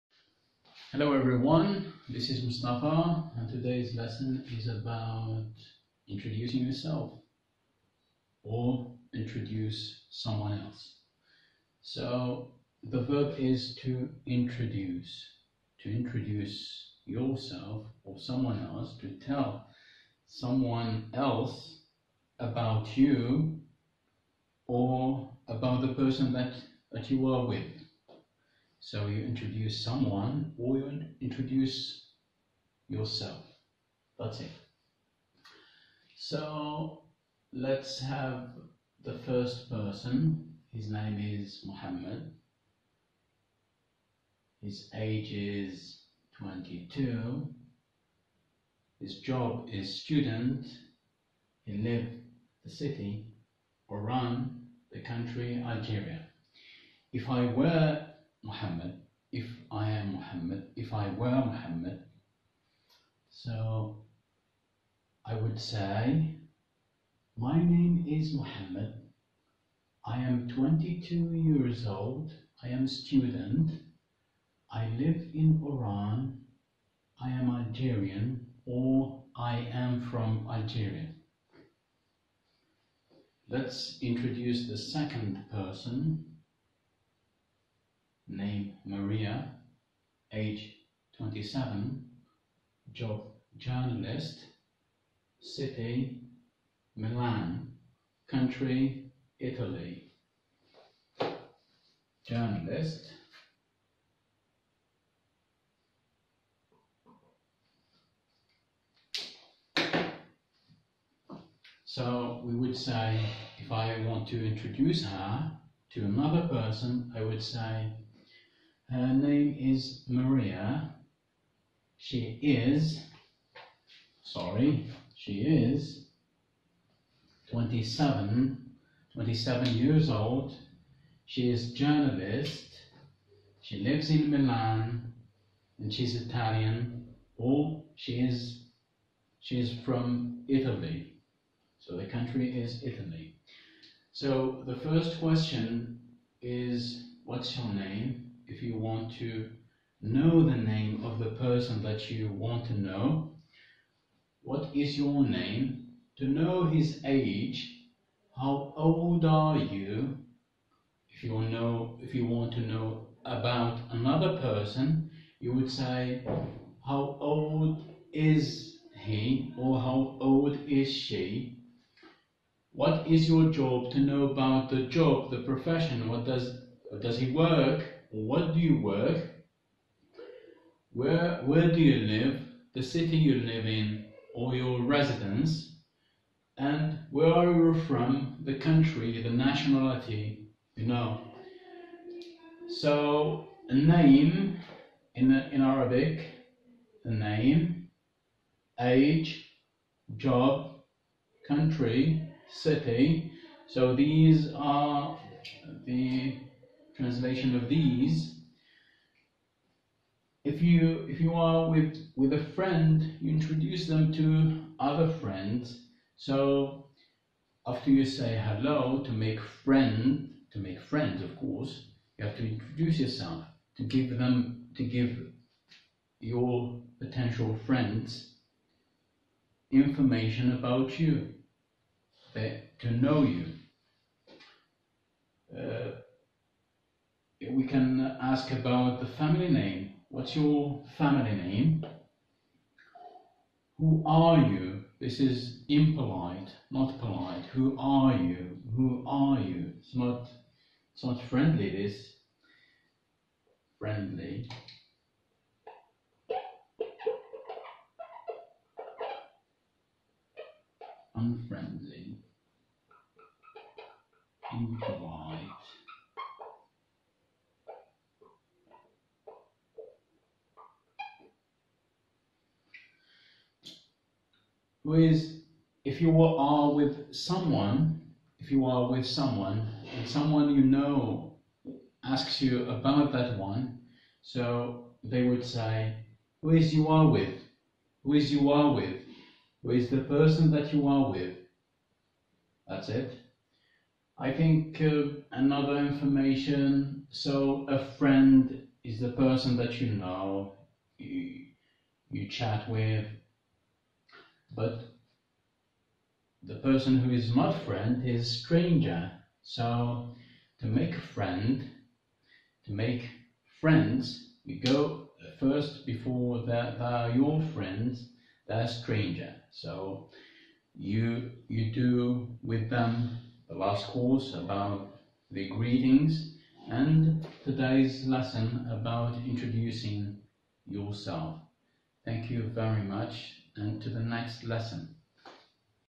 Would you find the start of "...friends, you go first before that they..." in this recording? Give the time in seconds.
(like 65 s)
313 s.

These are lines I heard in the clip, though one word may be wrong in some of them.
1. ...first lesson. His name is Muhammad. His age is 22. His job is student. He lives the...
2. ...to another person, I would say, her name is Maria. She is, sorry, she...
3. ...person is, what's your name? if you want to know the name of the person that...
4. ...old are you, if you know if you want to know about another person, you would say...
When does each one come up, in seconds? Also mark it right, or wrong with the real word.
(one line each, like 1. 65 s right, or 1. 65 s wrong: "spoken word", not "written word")
1. 39 s wrong: "person", not "lesson"
2. 115 s right
3. 145 s wrong: "question", not "person"
4. 158 s right.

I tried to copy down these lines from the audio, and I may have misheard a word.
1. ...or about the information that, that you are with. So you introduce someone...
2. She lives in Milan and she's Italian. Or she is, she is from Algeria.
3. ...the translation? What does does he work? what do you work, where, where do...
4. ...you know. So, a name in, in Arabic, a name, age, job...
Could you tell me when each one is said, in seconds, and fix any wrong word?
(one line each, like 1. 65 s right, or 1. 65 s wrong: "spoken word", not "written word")
1. 24 s wrong: "person", not "information"
2. 133 s wrong: "Italy", not "Algeria"
3. 175 s wrong: "profession", not "translation"
4. 190 s right.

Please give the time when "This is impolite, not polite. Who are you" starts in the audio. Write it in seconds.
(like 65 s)
244 s.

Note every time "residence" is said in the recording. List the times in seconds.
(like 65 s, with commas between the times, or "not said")
184 s.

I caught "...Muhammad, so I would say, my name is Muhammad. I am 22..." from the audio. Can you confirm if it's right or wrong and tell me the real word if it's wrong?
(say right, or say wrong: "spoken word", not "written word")
right.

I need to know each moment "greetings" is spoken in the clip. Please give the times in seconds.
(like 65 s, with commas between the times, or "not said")
325 s.